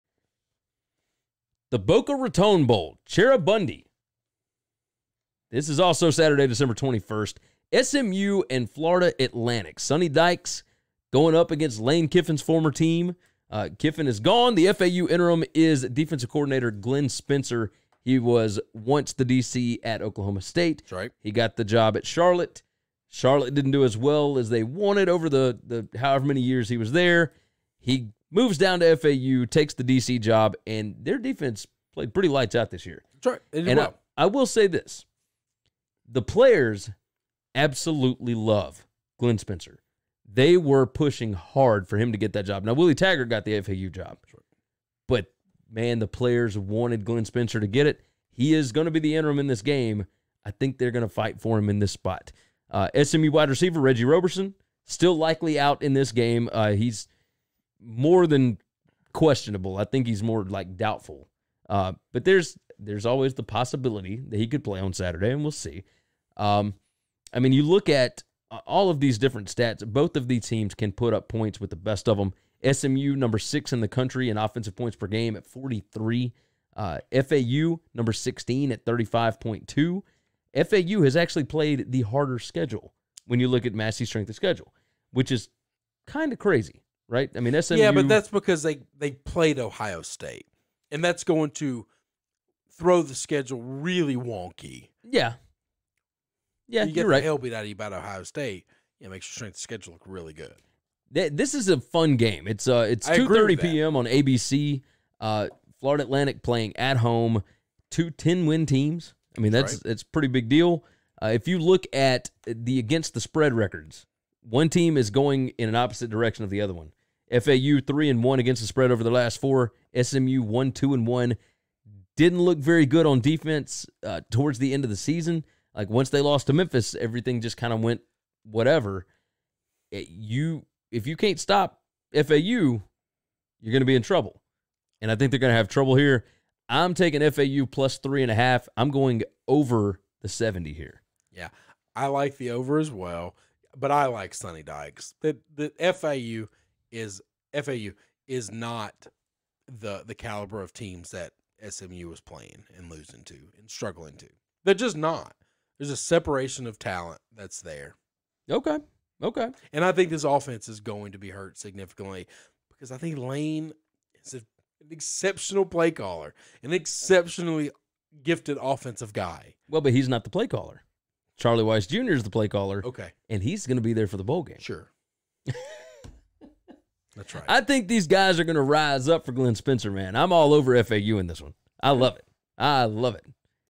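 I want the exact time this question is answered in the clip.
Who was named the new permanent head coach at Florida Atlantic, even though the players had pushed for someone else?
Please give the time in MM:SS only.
00:42.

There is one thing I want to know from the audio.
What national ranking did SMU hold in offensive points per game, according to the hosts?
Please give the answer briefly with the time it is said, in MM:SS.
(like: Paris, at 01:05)
6, at 01:13.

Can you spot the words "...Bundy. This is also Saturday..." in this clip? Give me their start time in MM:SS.
00:03.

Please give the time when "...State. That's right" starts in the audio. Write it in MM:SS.
00:20.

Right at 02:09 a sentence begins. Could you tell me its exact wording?
It, you if you can't stop FAU, you're going to be in trouble, and I think they're going to have trouble here.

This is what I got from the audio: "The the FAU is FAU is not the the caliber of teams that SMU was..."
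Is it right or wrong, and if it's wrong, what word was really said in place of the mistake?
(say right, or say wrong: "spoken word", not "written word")
right.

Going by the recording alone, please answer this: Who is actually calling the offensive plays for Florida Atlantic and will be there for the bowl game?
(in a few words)
Charlie Weis Jr.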